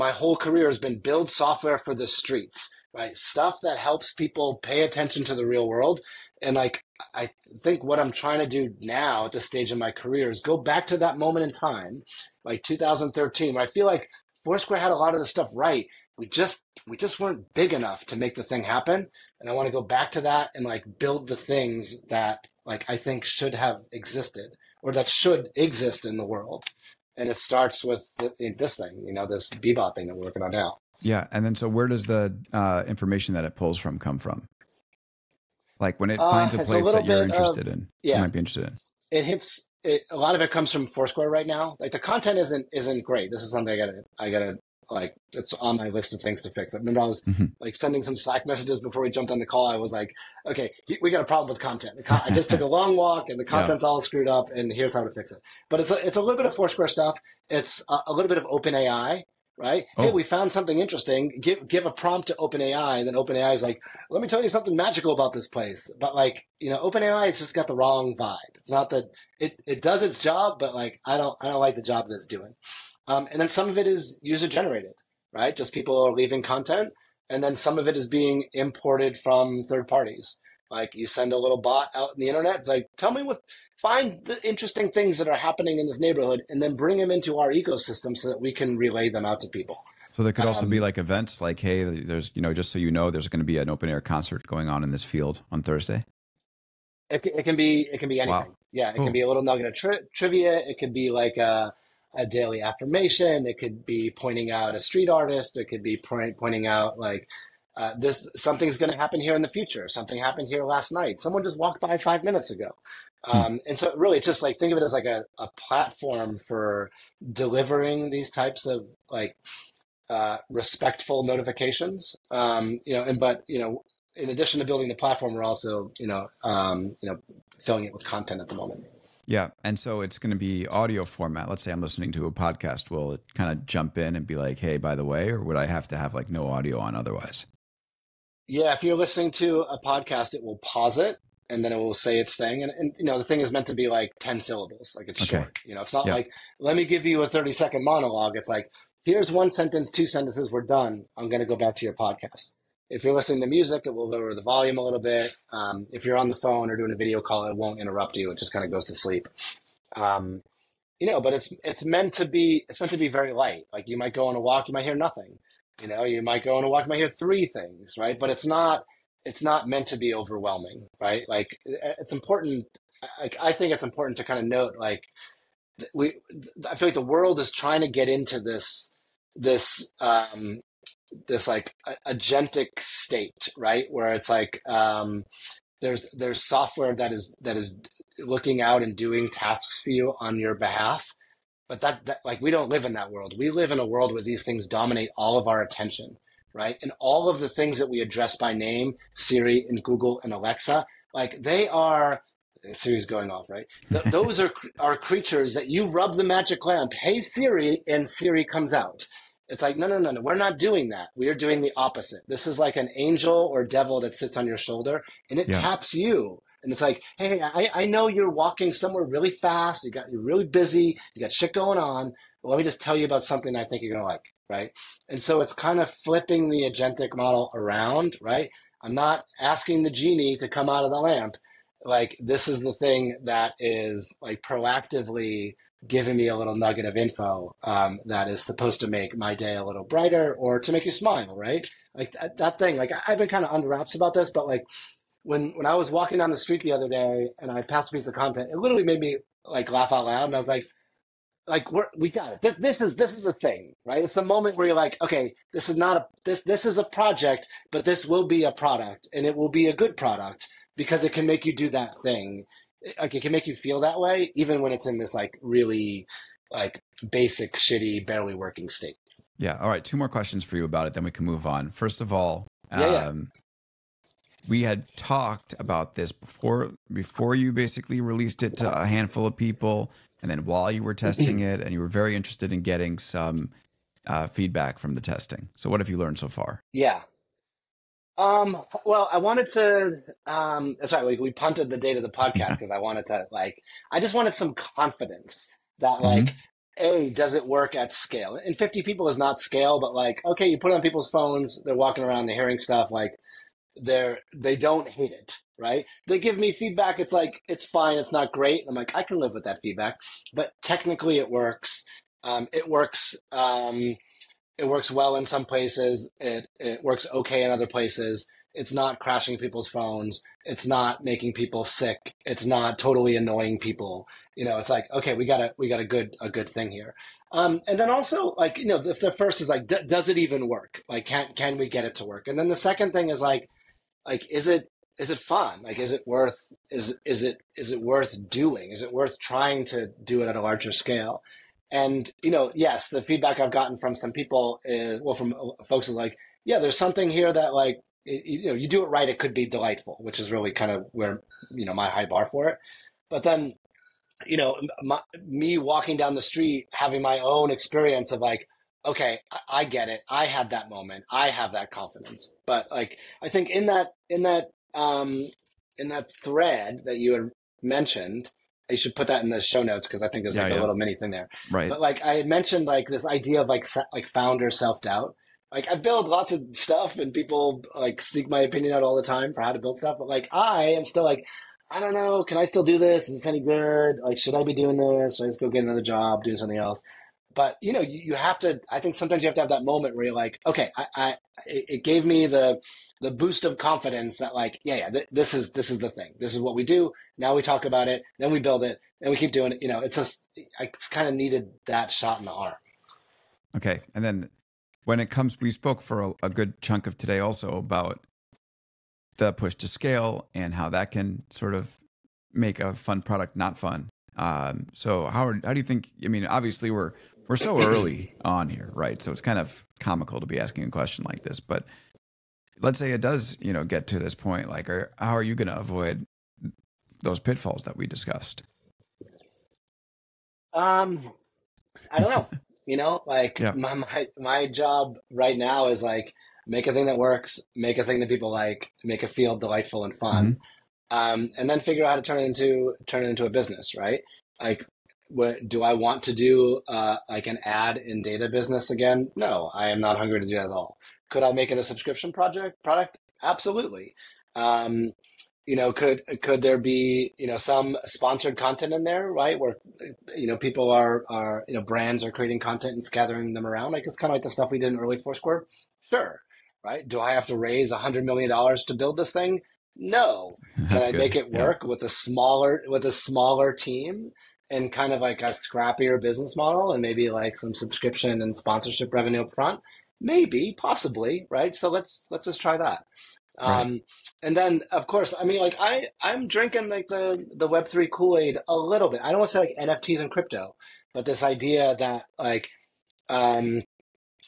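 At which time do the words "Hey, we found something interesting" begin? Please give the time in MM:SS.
01:00.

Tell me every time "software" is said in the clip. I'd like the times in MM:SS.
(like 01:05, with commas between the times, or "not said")
00:01, 03:06.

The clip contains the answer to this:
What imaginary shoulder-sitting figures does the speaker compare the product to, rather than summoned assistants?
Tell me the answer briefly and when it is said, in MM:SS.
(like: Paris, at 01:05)
angel or devil, at 03:32.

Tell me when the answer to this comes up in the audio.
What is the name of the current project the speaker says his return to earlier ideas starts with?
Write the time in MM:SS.
00:29.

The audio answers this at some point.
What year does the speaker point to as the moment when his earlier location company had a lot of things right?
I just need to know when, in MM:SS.
00:12.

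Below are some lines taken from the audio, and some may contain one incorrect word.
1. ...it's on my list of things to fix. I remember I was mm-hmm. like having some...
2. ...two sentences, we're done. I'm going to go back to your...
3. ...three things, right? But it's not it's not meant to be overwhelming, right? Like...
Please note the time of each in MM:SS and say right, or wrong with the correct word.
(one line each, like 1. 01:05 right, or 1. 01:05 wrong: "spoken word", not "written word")
1. 00:45 wrong: "sending", not "having"
2. 02:29 right
3. 02:47 right.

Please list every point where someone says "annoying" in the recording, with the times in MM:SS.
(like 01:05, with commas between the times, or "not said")
05:23.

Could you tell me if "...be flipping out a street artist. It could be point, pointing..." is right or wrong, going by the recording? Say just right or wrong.
wrong.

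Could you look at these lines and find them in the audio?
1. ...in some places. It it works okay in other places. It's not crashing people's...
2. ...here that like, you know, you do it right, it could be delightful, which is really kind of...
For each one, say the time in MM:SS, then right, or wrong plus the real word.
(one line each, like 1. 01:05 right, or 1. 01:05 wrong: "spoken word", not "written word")
1. 05:15 right
2. 05:47 right.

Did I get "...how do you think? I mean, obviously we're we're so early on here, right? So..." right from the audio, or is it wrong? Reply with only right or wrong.
right.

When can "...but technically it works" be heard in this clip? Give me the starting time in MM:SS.
05:10.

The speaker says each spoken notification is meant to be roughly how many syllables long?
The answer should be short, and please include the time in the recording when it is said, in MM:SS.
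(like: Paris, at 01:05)
10, at 02:24.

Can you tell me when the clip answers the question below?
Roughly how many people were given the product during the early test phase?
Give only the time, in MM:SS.
04:58.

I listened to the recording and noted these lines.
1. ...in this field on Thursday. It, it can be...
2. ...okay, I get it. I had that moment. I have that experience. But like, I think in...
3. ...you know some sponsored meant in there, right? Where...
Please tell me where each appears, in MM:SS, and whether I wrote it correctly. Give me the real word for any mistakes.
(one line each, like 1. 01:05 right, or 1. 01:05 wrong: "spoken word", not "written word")
1. 01:34 right
2. 05:58 wrong: "confidence", not "experience"
3. 07:37 wrong: "content", not "meant".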